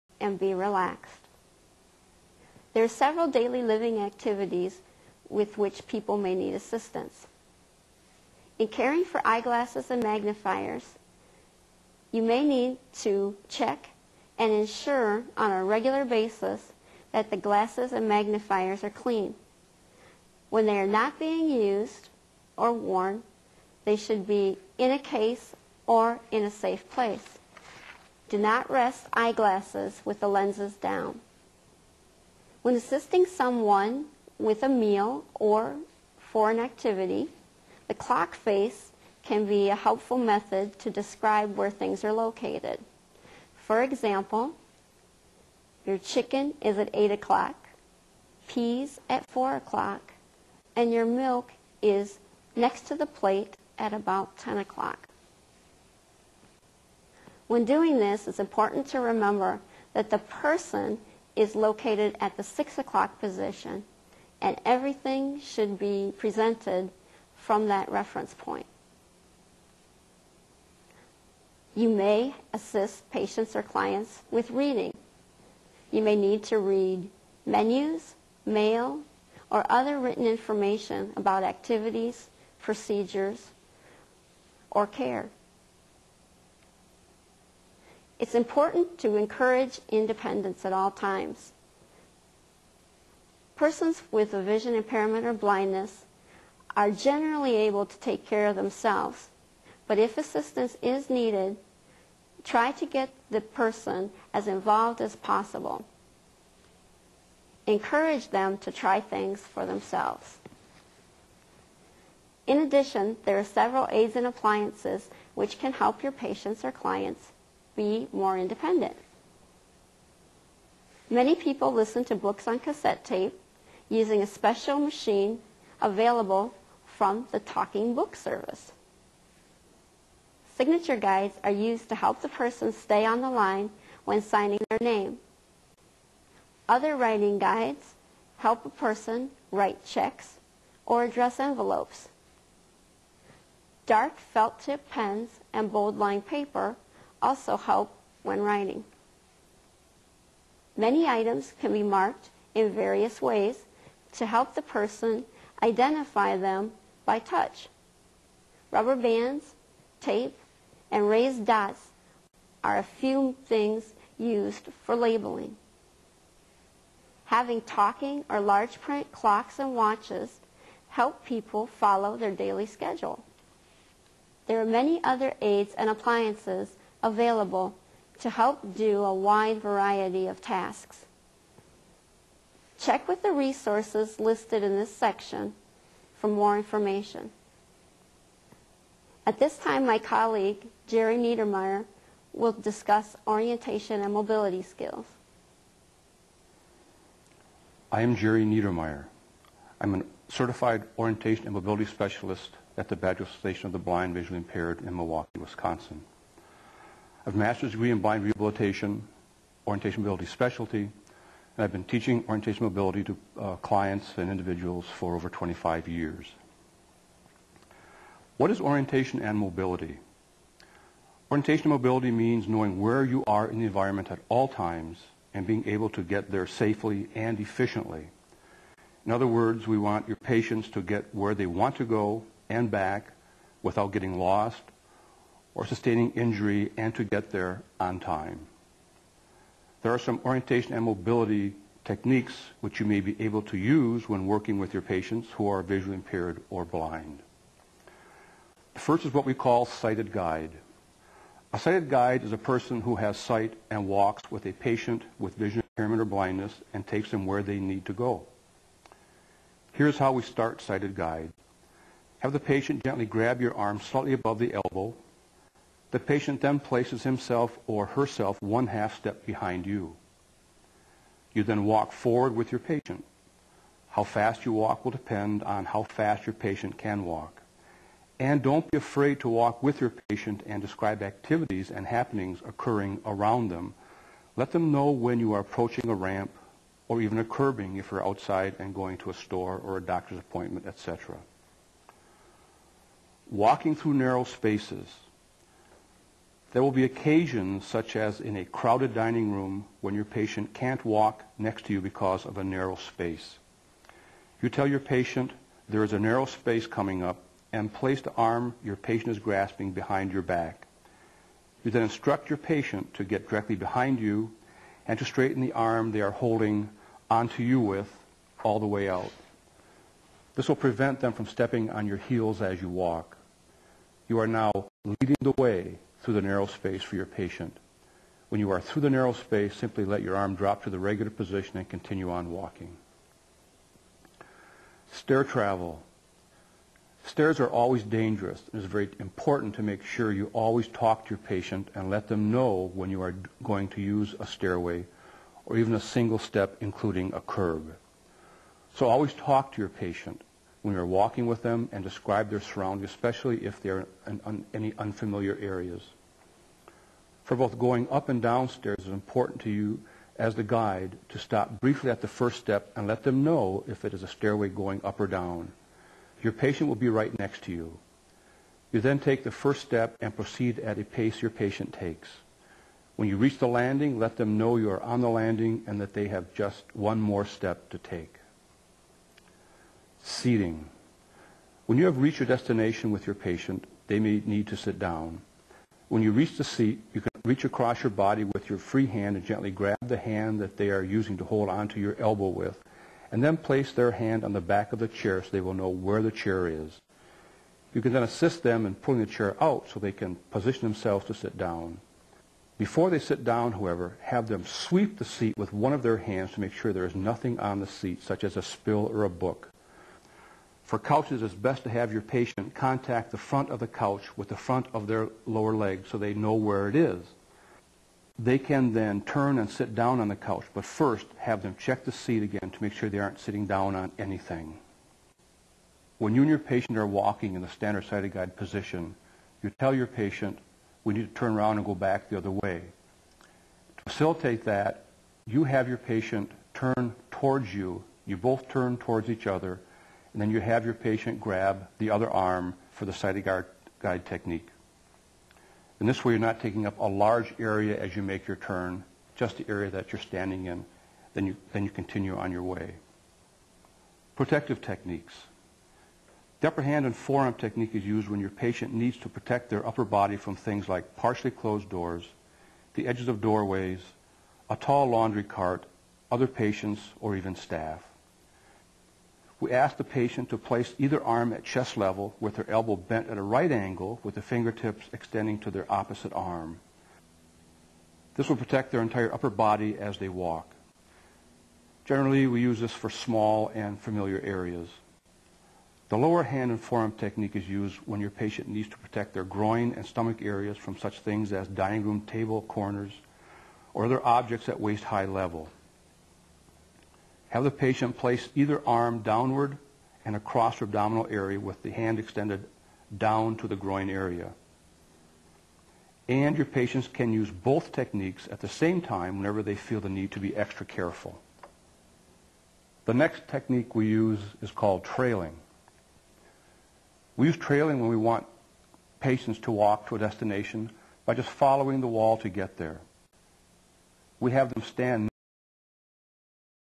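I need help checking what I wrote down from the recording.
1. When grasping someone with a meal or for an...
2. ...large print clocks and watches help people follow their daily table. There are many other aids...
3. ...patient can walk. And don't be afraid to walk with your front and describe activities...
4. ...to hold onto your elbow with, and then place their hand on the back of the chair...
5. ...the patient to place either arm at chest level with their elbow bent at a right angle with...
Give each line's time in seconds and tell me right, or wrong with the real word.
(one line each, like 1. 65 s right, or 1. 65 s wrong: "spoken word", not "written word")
1. 32 s wrong: "assisting", not "grasping"
2. 168 s wrong: "schedule", not "table"
3. 276 s wrong: "patient", not "front"
4. 391 s right
5. 469 s right.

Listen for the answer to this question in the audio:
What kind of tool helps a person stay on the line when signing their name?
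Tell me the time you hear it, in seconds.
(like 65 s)
130 s.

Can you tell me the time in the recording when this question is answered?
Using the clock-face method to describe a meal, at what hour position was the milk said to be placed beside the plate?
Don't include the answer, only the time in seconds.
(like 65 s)
54 s.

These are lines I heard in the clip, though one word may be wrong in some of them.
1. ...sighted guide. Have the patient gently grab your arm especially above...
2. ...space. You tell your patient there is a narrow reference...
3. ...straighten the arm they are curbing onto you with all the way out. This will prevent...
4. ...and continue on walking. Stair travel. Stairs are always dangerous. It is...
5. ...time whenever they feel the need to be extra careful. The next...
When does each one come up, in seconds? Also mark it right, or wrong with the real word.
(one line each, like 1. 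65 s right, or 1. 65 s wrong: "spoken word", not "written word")
1. 260 s wrong: "slightly", not "especially"
2. 302 s wrong: "space", not "reference"
3. 315 s wrong: "holding", not "curbing"
4. 331 s right
5. 508 s right.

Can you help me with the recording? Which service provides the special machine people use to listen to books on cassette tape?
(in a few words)
Talking Book Service.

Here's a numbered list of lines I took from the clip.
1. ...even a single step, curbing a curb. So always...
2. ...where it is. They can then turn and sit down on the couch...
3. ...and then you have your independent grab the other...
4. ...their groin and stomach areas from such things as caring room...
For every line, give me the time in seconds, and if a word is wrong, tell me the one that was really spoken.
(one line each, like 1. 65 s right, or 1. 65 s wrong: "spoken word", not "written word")
1. 345 s wrong: "including", not "curbing"
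2. 416 s right
3. 440 s wrong: "patient", not "independent"
4. 489 s wrong: "dining", not "caring".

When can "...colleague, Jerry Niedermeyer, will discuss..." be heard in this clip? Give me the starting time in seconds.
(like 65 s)
189 s.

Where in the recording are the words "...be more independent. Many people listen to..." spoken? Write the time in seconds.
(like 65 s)
117 s.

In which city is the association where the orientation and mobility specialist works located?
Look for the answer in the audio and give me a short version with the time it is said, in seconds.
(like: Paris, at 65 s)
Milwaukee, at 204 s.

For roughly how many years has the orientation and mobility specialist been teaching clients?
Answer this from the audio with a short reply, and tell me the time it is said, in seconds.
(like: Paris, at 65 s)
25, at 215 s.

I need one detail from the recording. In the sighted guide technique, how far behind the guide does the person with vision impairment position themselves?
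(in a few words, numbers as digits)
one half step.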